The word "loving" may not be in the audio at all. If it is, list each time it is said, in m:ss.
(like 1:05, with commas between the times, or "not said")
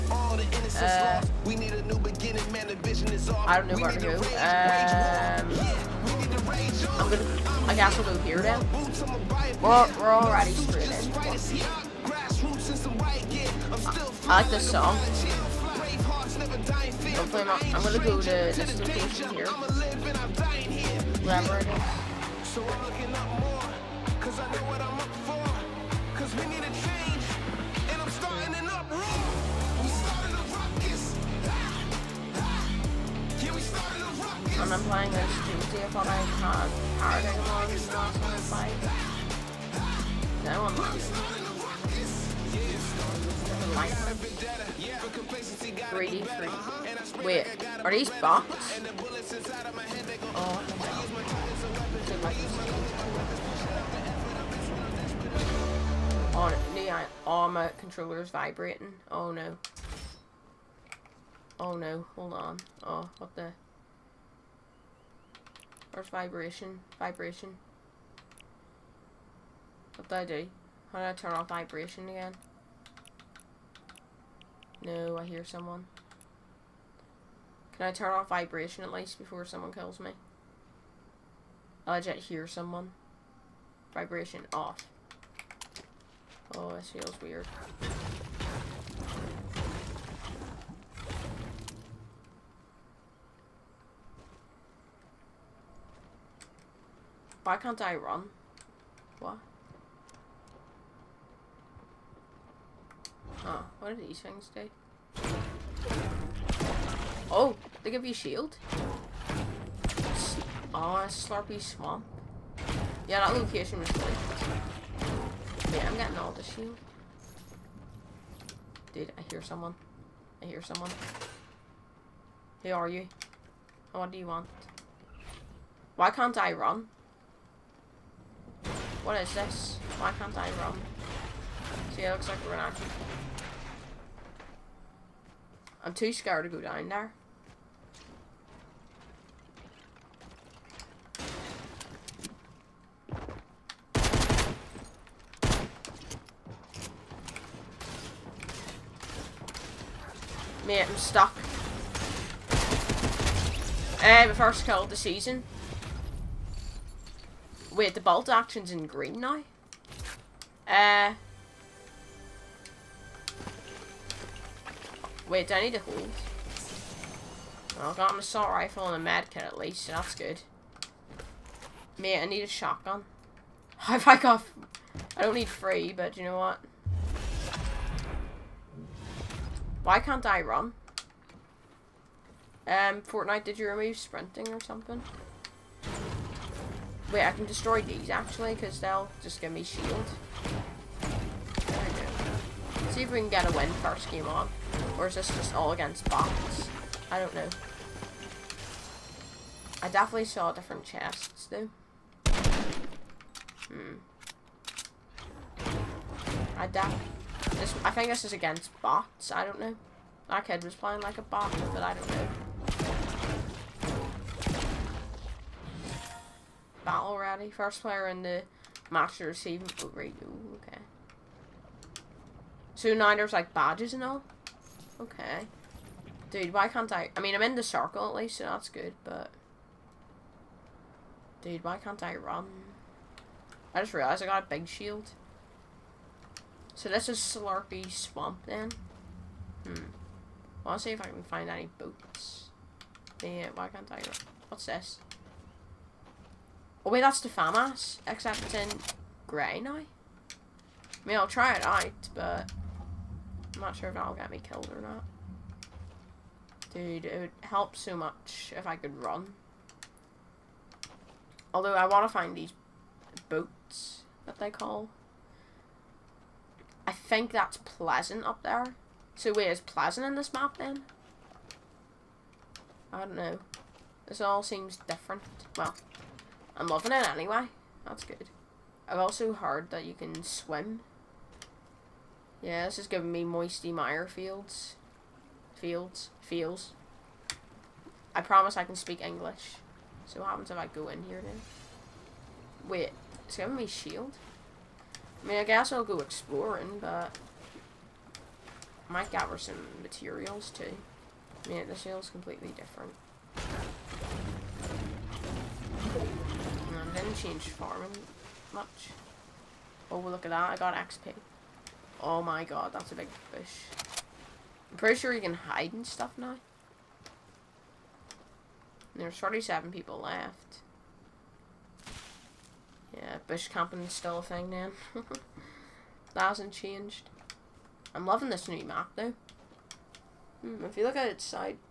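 4:36, 5:28.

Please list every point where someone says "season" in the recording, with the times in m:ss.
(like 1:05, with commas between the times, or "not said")
2:34.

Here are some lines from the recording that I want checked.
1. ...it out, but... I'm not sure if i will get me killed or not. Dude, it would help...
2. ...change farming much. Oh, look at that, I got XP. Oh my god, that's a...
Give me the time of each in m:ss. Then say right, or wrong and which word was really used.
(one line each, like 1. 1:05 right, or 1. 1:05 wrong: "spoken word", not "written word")
1. 4:11 right
2. 5:07 right.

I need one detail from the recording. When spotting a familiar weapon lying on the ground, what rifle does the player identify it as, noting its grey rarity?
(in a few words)
FAMAS.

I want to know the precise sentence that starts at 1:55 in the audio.
Yeah, I'm getting all the shield.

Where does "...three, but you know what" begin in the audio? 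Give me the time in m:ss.
2:55.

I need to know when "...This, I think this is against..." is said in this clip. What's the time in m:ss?
3:26.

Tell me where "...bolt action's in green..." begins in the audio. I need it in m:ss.
2:38.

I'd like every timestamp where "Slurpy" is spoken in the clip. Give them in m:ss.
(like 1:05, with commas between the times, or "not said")
1:51, 3:57.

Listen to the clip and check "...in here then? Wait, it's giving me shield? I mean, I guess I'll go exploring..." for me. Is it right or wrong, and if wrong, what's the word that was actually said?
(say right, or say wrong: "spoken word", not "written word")
right.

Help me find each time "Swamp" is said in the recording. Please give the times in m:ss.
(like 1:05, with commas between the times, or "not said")
1:51, 3:57.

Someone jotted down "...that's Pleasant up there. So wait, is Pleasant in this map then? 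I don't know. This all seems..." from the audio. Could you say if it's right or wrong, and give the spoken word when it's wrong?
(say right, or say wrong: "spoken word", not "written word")
right.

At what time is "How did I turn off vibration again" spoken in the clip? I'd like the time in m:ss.
1:10.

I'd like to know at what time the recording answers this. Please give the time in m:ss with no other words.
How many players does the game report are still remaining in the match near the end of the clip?
5:19.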